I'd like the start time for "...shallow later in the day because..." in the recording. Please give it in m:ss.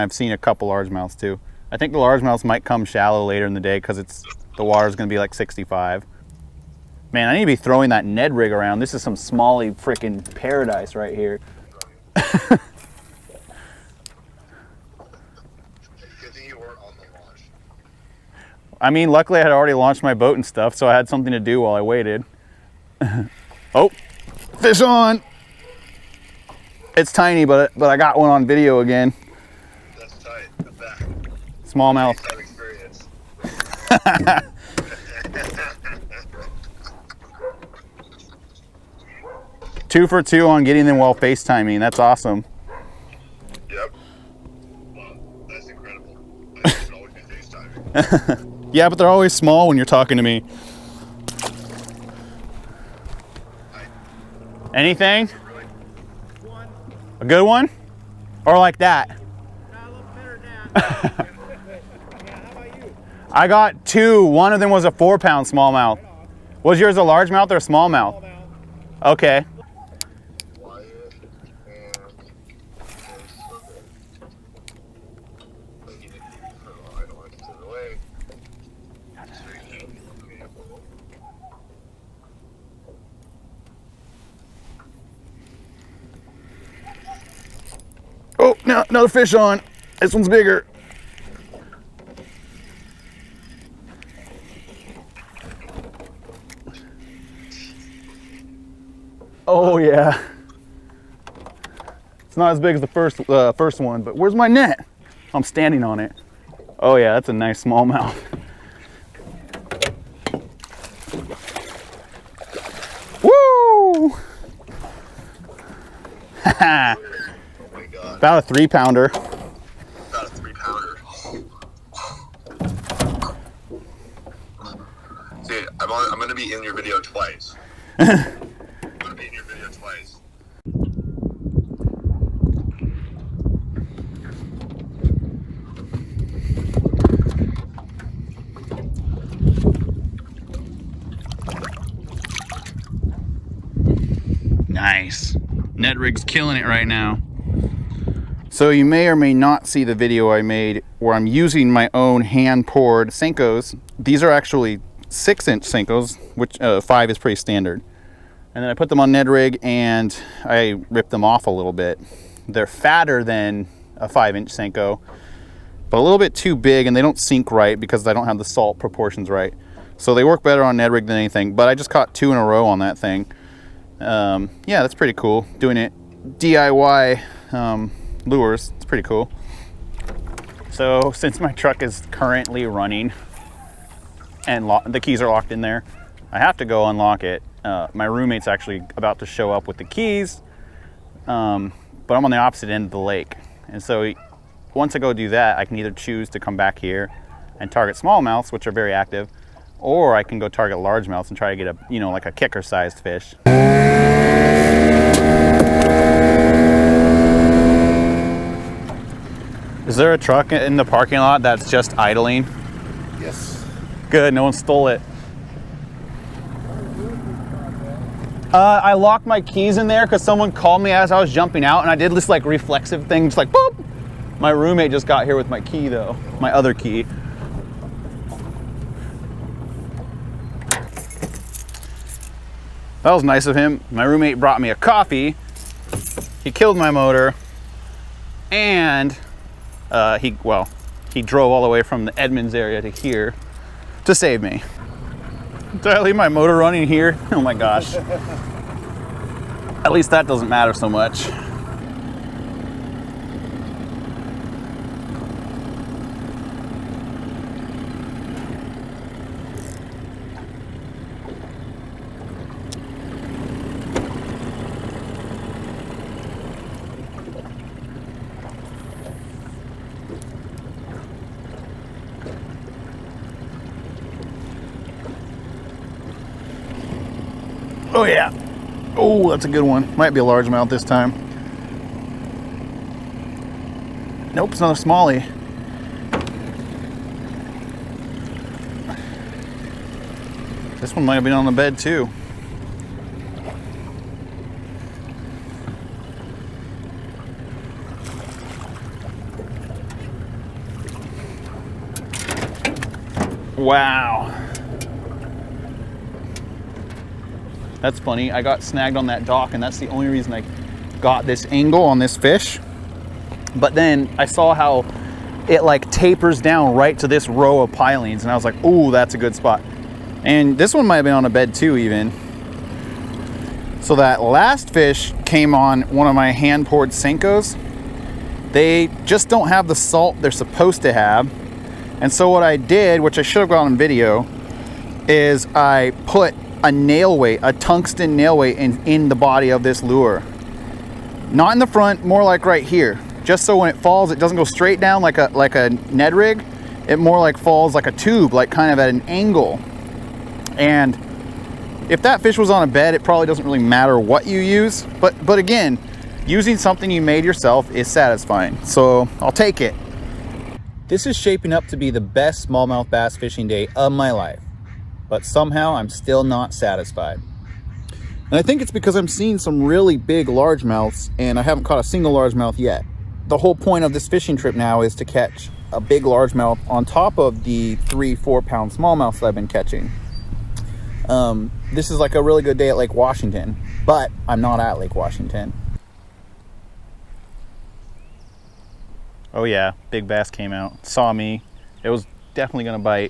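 0:02.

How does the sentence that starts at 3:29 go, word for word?
Is there a truck in the parking lot that's just idling?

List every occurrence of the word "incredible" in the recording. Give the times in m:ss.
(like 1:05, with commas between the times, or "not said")
0:45.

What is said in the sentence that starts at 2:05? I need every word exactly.
I'm gonna be in your video twice.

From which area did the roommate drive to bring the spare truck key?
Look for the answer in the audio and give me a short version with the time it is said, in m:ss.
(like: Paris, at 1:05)
Edmonds, at 4:02.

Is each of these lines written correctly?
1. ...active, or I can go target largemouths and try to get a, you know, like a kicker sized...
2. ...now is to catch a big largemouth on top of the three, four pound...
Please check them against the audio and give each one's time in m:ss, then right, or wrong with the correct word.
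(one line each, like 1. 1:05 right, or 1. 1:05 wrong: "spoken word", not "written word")
1. 3:18 right
2. 6:14 right.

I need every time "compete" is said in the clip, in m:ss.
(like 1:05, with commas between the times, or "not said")
not said.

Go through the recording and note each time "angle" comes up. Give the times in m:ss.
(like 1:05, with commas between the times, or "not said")
5:11, 5:49.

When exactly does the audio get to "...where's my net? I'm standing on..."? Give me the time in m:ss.
1:44.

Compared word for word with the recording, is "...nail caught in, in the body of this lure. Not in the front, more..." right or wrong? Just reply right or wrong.
wrong.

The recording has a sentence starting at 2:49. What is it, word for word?
So they work better on Ned Rig than anything, but I just caught two in a row on that thing.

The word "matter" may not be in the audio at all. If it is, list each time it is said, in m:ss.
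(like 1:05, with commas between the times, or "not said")
4:10, 5:53.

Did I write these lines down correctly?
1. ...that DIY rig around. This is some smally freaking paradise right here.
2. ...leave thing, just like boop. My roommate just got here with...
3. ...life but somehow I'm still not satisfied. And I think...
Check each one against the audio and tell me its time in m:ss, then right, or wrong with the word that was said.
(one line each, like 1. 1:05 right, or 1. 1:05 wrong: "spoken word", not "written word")
1. 0:07 wrong: "Ned", not "DIY"
2. 3:42 wrong: "reflexive", not "leave"
3. 6:04 right.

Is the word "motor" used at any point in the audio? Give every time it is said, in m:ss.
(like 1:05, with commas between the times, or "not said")
3:56, 4:06.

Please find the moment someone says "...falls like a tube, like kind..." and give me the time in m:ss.
5:47.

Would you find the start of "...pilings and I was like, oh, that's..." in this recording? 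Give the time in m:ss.
5:17.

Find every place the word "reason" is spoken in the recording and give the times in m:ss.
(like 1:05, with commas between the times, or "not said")
5:10.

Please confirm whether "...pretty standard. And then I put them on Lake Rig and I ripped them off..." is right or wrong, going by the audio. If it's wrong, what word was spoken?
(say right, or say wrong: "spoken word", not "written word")
wrong: "Ned", not "Lake".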